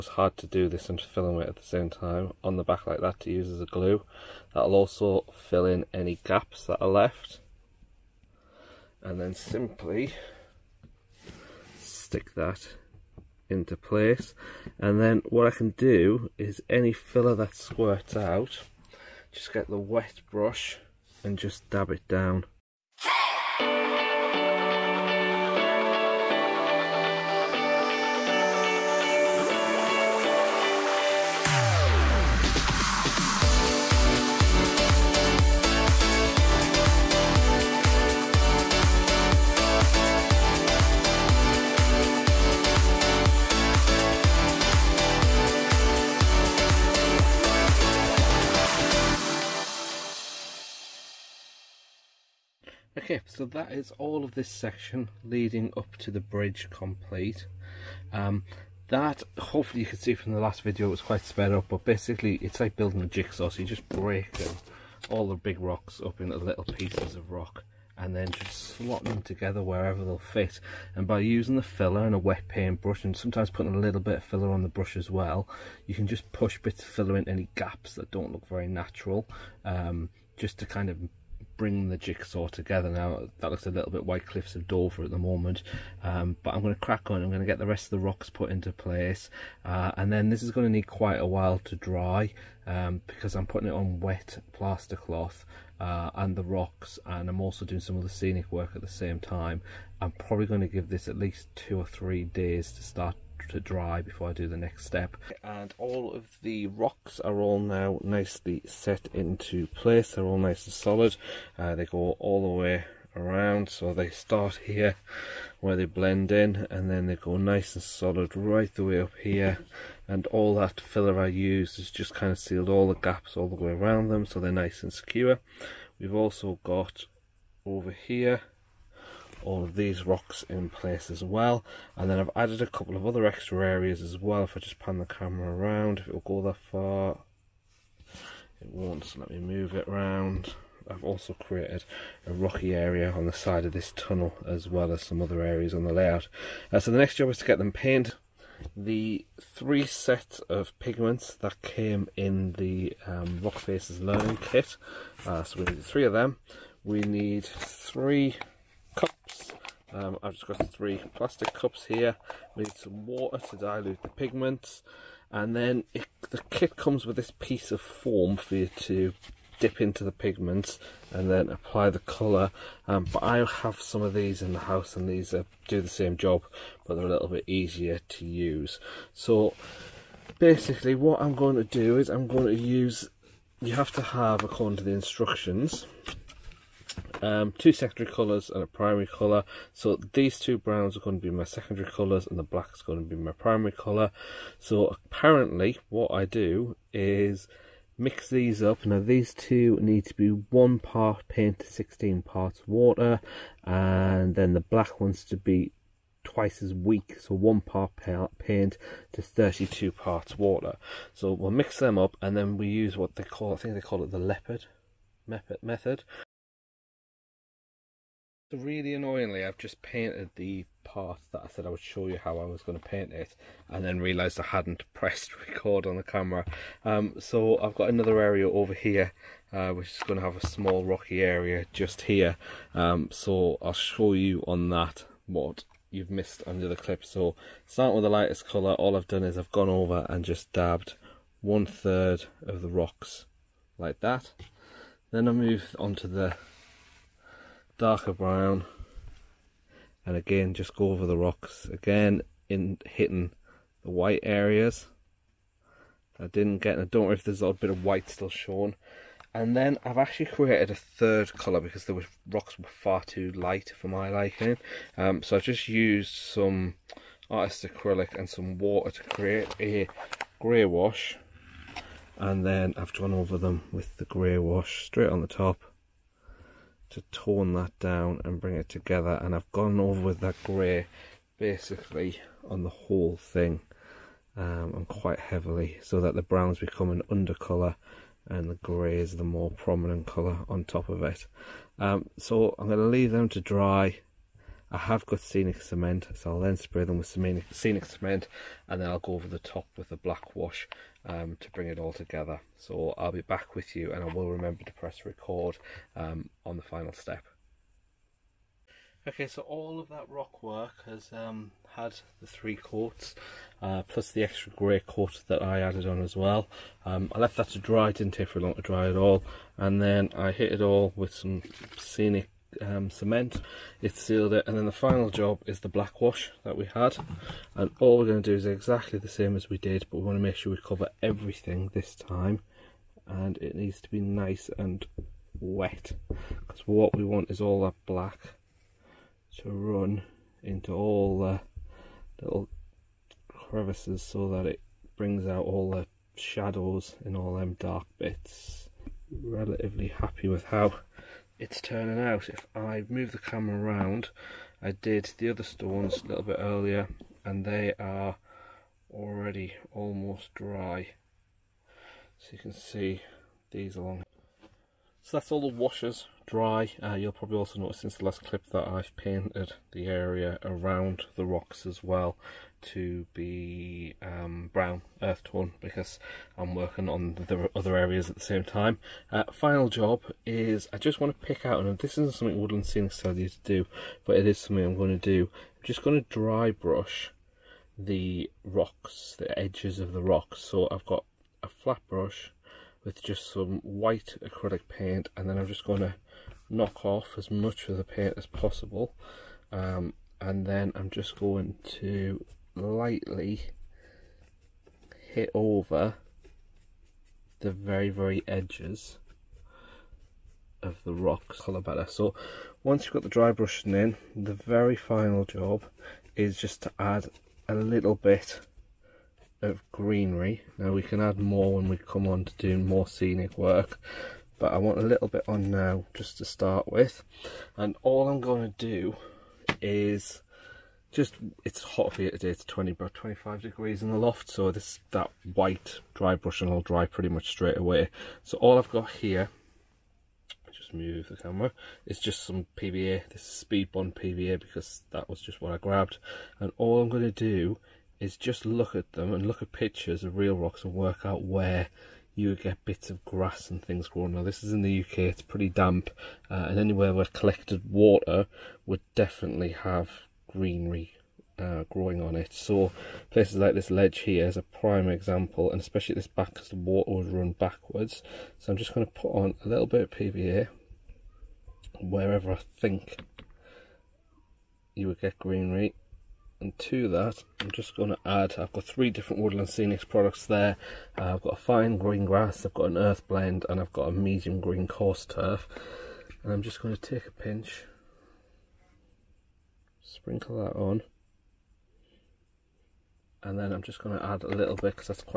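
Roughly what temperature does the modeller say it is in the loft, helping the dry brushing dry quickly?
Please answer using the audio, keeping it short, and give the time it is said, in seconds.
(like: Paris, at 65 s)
25 degrees, at 432 s.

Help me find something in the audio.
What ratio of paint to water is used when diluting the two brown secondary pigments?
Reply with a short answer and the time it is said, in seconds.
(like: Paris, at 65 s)
1 part paint to 16 parts water, at 200 s.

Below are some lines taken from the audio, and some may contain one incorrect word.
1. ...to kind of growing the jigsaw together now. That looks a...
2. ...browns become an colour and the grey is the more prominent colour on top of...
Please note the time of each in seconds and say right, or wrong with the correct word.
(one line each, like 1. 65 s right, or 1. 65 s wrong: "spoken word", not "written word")
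1. 80 s wrong: "bring", not "growing"
2. 286 s right.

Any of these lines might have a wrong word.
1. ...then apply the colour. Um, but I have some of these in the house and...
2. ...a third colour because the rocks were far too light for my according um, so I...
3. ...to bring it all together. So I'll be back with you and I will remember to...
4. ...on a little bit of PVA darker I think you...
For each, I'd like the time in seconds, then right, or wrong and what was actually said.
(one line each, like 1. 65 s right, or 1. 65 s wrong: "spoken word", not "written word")
1. 171 s right
2. 260 s wrong: "liking", not "according"
3. 301 s right
4. 469 s wrong: "wherever", not "darker".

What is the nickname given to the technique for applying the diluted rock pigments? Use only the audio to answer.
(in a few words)
leopard method.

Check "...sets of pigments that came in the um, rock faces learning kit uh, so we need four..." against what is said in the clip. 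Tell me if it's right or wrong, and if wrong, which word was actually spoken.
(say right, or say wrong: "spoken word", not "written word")
wrong: "three", not "four".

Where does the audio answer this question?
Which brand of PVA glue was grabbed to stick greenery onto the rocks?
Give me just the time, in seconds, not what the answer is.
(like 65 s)
443 s.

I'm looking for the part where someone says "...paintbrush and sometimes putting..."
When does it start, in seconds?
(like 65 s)
72 s.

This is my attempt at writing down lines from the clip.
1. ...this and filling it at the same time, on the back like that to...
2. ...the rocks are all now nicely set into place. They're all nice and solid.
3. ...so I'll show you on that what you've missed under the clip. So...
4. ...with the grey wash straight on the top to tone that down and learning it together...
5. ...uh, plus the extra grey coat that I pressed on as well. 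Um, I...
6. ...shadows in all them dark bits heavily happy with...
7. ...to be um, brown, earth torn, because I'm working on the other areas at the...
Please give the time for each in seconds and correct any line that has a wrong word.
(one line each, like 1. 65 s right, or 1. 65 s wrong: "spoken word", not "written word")
1. 0 s right
2. 106 s right
3. 233 s right
4. 273 s wrong: "bring", not "learning"
5. 313 s wrong: "added", not "pressed"
6. 346 s wrong: "relatively", not "heavily"
7. 372 s right.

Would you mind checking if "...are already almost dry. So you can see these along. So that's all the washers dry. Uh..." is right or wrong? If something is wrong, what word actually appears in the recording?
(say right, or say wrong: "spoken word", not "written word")
right.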